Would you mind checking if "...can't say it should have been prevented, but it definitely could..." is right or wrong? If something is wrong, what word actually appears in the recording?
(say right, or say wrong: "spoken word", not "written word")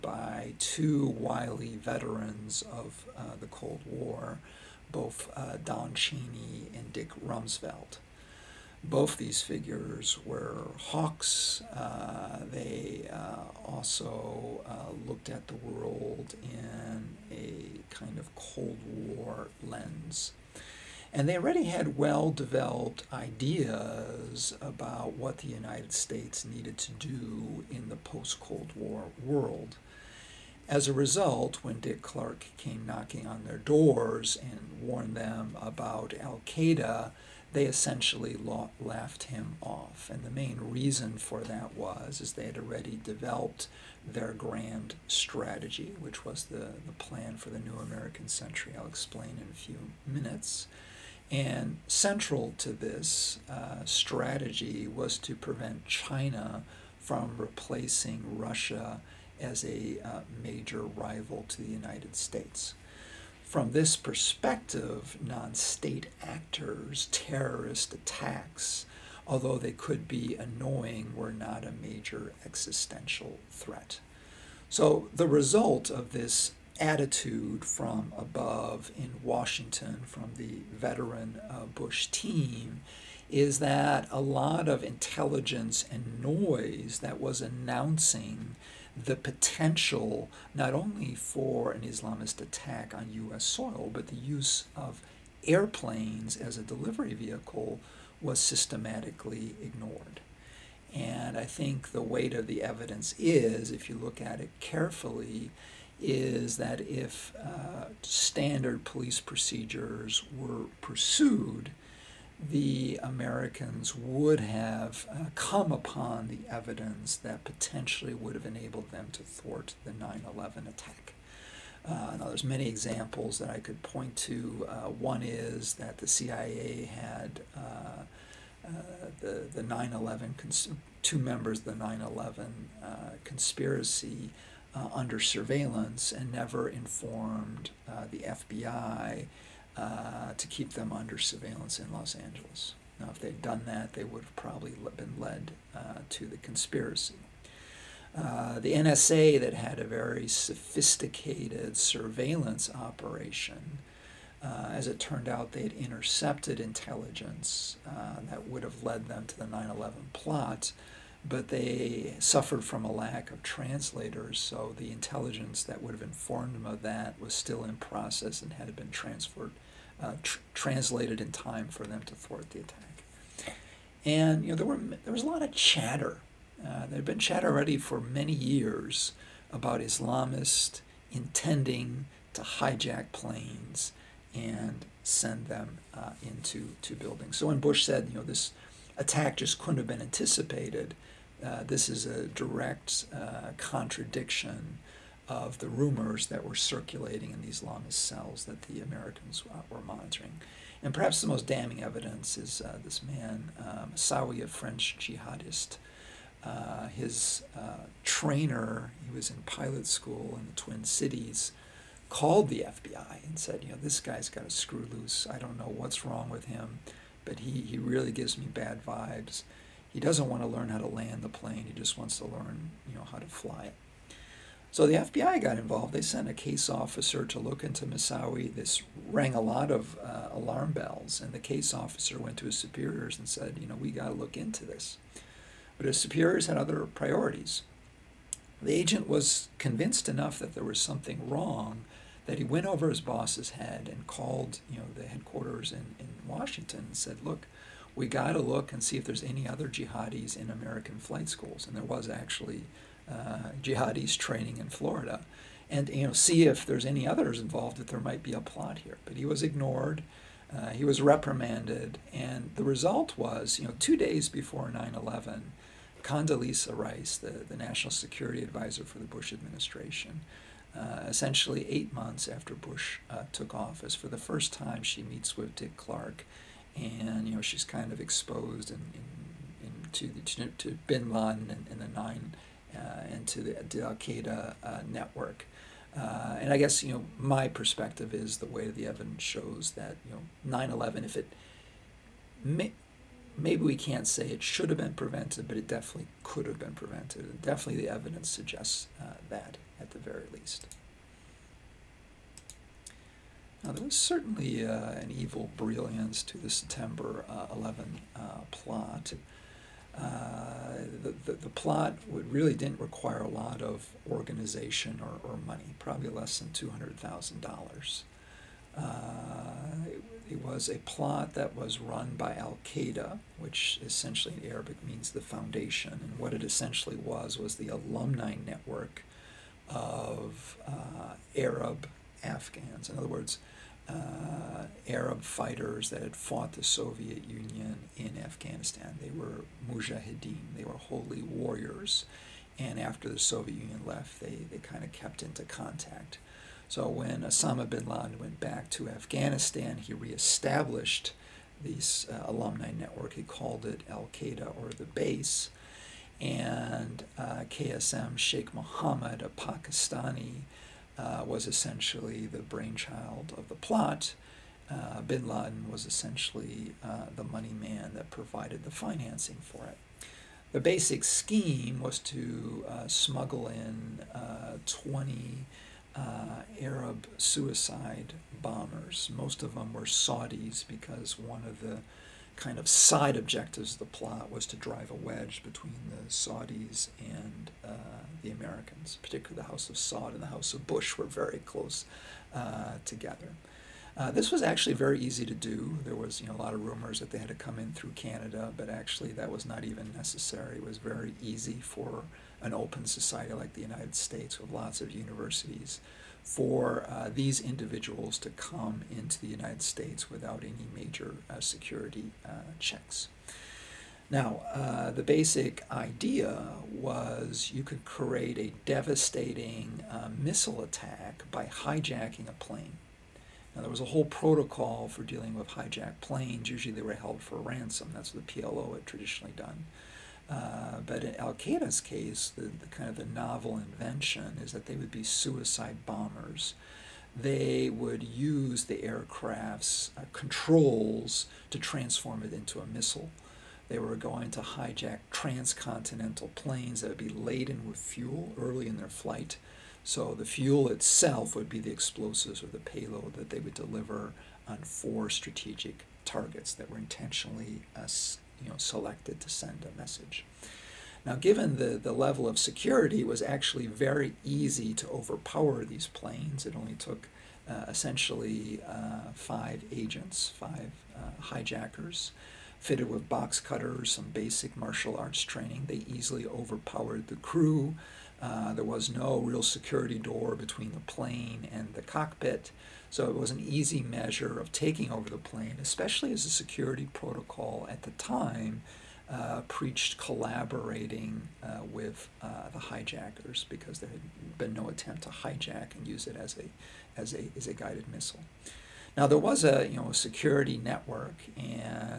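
right.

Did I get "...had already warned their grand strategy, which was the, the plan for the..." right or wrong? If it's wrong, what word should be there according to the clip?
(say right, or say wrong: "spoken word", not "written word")
wrong: "developed", not "warned".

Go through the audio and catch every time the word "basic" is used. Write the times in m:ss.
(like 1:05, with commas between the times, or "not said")
6:10, 6:55, 7:54.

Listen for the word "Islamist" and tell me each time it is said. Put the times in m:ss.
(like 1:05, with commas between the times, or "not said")
1:31, 2:59, 3:17.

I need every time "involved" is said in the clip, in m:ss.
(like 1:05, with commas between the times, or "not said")
3:45, 4:17.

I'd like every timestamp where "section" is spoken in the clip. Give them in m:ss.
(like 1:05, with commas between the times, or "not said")
not said.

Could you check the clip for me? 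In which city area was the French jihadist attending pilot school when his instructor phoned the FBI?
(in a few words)
Twin Cities.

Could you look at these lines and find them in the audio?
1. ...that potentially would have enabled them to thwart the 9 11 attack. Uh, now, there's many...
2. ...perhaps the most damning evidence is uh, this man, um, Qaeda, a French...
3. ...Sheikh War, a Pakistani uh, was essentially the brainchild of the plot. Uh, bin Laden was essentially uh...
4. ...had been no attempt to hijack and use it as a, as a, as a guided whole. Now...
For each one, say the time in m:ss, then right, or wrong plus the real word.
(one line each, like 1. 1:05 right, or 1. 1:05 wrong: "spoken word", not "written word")
1. 1:57 right
2. 3:20 wrong: "Moussaoui", not "Qaeda"
3. 5:58 wrong: "Mohammed", not "War"
4. 8:13 wrong: "missile", not "whole".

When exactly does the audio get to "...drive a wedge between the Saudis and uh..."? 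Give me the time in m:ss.
6:24.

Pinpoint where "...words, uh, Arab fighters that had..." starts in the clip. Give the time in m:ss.
5:33.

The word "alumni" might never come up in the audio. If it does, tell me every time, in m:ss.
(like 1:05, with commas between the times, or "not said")
5:27, 5:52.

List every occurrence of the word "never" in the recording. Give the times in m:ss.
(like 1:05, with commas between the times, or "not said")
2:16.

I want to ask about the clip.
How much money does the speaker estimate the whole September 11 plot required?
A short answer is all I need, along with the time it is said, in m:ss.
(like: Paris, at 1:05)
less than $200,000, at 5:16.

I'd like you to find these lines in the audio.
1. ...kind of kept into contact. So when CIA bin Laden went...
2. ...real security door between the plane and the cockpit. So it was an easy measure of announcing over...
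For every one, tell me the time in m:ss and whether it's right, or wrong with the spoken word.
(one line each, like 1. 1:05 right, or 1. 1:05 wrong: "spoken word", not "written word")
1. 5:44 wrong: "Osama", not "CIA"
2. 7:59 wrong: "taking", not "announcing".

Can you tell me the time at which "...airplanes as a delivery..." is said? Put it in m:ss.
1:35.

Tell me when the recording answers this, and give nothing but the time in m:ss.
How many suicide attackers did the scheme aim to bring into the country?
6:14.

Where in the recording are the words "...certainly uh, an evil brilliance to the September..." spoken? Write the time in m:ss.
5:03.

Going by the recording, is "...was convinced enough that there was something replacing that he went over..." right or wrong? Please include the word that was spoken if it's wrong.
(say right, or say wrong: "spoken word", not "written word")
wrong: "wrong", not "replacing".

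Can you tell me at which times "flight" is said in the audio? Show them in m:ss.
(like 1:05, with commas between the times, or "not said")
4:10, 7:28.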